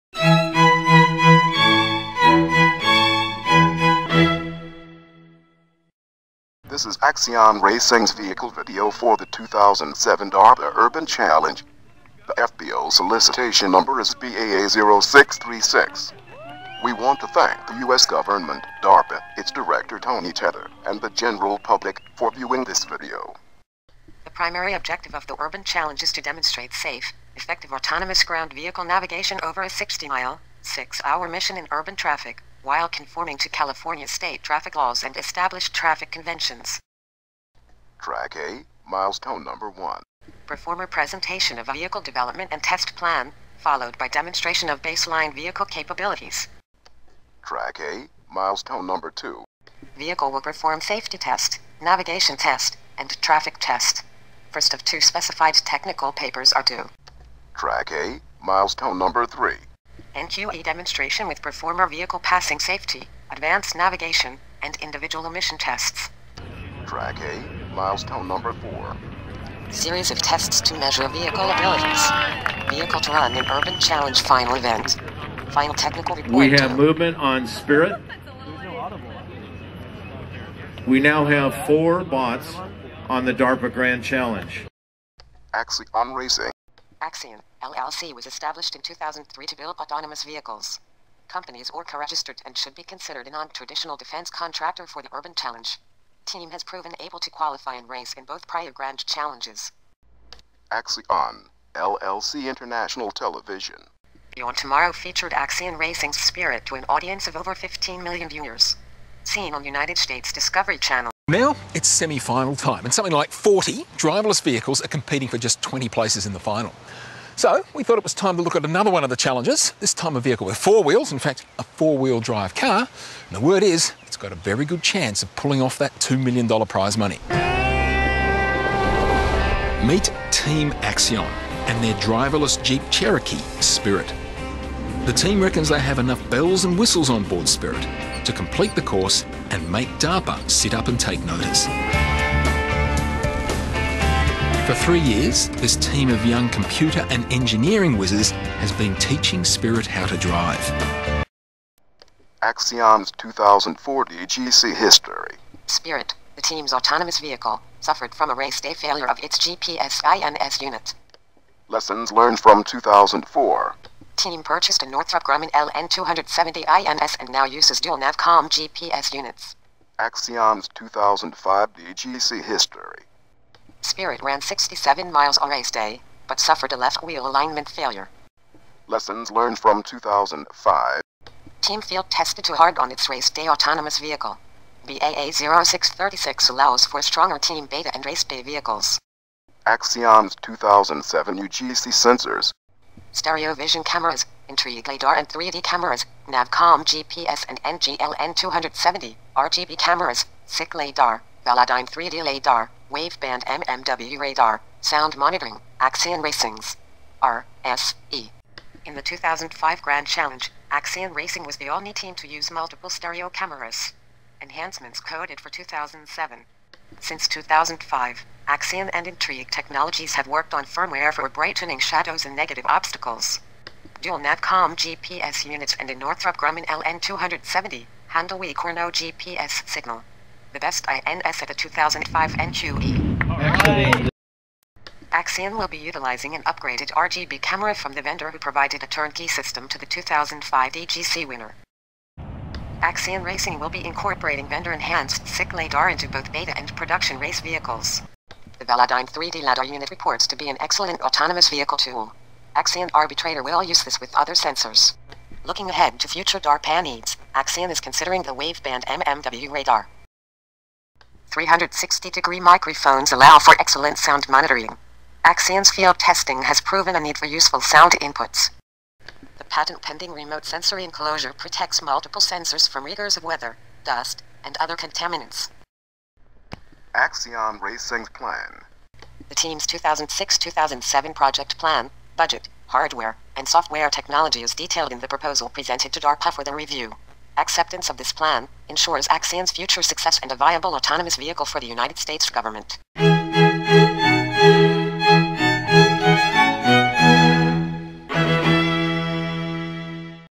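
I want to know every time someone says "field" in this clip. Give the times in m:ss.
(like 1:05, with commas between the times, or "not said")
3:01, 4:25.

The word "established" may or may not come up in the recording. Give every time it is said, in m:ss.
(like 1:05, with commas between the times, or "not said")
0:35, 1:28.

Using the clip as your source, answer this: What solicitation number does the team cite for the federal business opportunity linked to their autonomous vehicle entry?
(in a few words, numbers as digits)
BAA0636.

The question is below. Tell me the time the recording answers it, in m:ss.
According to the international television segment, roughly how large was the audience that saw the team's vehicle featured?
1:47.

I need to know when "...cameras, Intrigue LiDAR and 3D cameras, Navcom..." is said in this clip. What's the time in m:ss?
3:13.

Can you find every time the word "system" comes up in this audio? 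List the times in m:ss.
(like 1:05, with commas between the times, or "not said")
3:59.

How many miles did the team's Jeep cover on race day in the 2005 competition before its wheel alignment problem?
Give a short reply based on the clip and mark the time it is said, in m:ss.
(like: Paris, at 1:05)
67 miles, at 2:54.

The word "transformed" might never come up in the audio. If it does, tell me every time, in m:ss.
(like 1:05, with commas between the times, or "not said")
not said.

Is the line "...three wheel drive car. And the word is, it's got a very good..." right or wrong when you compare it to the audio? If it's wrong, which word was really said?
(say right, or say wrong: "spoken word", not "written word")
wrong: "four", not "three".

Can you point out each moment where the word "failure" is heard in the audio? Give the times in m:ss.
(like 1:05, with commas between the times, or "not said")
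2:38, 2:57.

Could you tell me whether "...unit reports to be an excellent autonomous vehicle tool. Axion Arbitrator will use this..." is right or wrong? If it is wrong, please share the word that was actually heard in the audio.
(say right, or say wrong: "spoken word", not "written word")
right.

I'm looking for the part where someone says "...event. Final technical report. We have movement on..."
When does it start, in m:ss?
1:14.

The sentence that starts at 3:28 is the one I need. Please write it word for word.
In the 2005 Grand Challenge, Axion Racing was the only team to use multiple stereo cameras.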